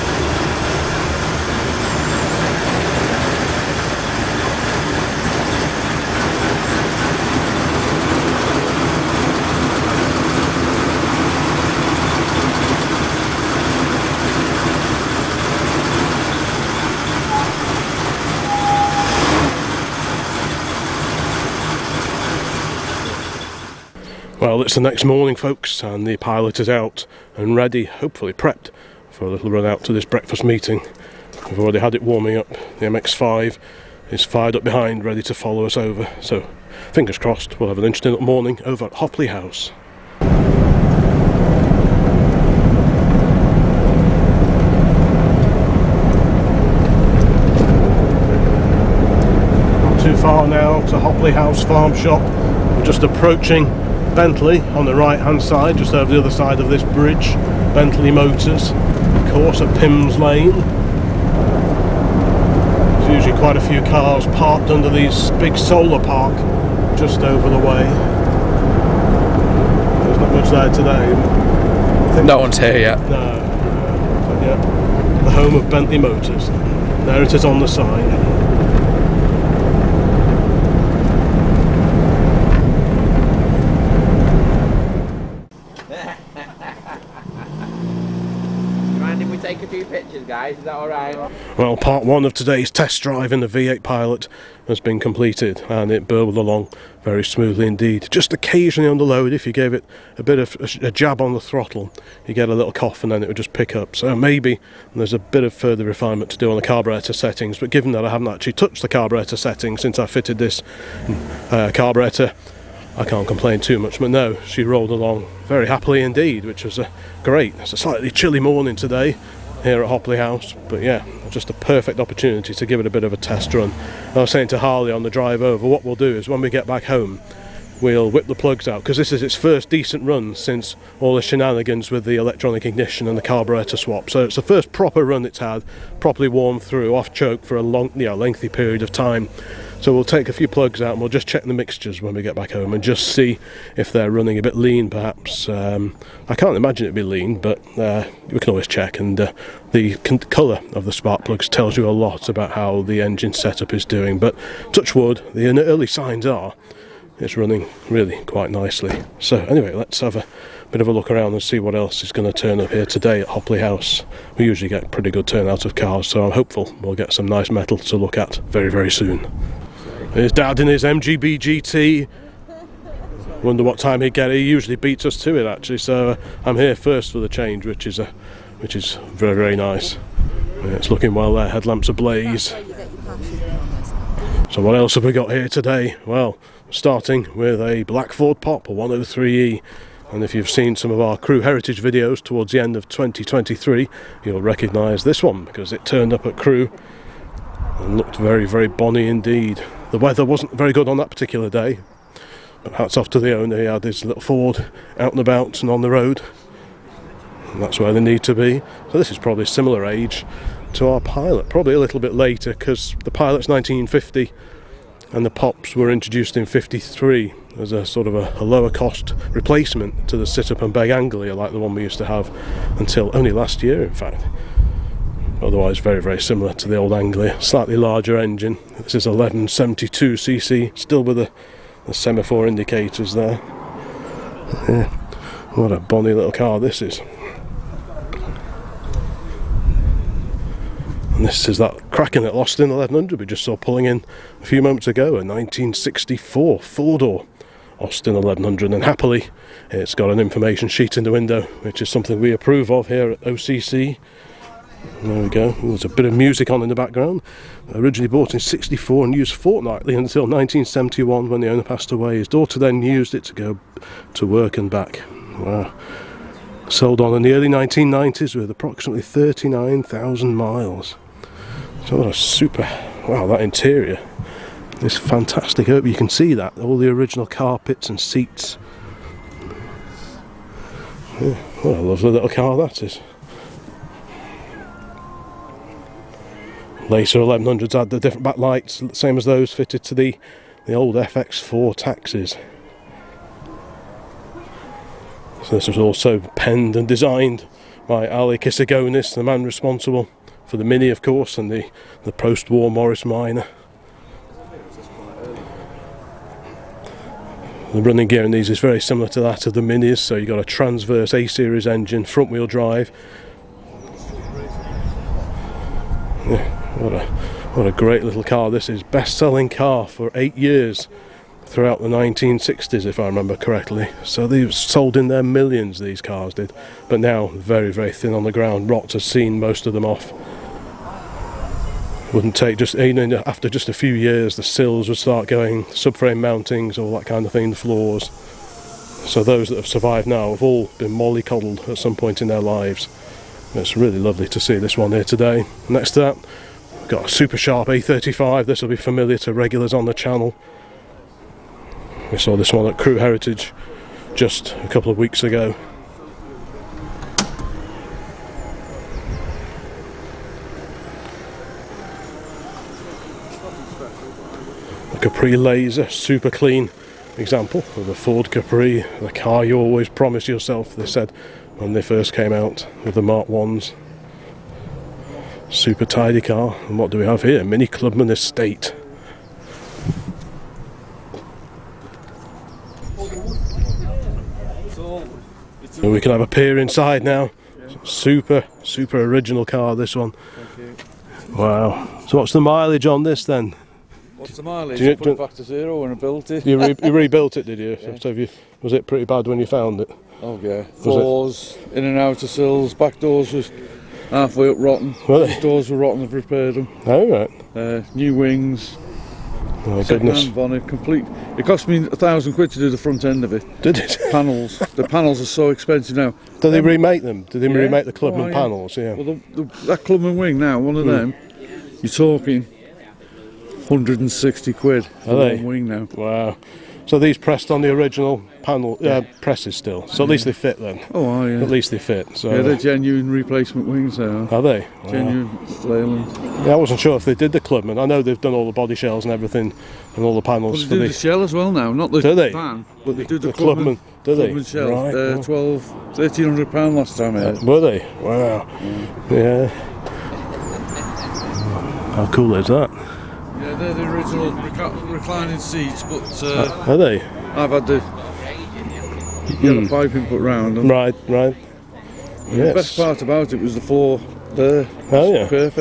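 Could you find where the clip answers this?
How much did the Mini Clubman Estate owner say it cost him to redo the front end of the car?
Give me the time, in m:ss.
6:51.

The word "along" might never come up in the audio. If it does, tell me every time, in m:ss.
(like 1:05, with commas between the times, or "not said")
1:36, 1:54.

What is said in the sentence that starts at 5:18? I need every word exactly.
Best-selling car for eight years throughout the 1960s, if I remember correctly.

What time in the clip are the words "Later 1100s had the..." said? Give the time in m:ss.
4:46.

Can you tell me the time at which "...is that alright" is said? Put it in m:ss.
1:30.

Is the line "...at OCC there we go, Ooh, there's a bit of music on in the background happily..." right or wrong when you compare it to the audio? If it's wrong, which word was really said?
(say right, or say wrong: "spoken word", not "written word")
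wrong: "originally", not "happily".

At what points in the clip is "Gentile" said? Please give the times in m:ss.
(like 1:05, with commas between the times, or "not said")
not said.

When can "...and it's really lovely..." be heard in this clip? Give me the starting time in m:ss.
5:43.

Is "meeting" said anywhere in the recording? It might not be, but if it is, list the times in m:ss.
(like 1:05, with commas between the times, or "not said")
0:30.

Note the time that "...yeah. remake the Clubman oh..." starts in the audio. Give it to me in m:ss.
6:57.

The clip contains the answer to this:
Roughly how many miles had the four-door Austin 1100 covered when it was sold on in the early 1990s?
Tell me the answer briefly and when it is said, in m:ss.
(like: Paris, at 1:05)
39,000 miles, at 4:29.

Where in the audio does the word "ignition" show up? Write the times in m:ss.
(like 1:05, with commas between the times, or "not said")
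2:12.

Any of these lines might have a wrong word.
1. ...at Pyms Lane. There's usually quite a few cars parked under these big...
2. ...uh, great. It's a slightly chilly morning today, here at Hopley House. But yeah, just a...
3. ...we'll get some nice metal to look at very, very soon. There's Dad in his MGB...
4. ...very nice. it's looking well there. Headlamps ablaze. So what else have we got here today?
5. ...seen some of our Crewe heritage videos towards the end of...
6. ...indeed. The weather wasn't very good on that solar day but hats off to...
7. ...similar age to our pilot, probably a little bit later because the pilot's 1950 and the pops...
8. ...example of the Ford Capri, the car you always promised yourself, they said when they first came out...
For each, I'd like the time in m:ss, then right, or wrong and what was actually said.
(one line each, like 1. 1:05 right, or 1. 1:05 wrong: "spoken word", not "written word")
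1. 0:59 right
2. 1:56 right
3. 2:46 right
4. 2:59 right
5. 3:10 right
6. 3:19 wrong: "particular", not "solar"
7. 3:29 right
8. 6:07 right.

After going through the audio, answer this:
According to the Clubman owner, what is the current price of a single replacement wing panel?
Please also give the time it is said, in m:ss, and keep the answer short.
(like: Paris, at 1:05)
£160, at 7:03.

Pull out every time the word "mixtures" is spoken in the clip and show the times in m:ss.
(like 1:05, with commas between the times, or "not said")
2:21.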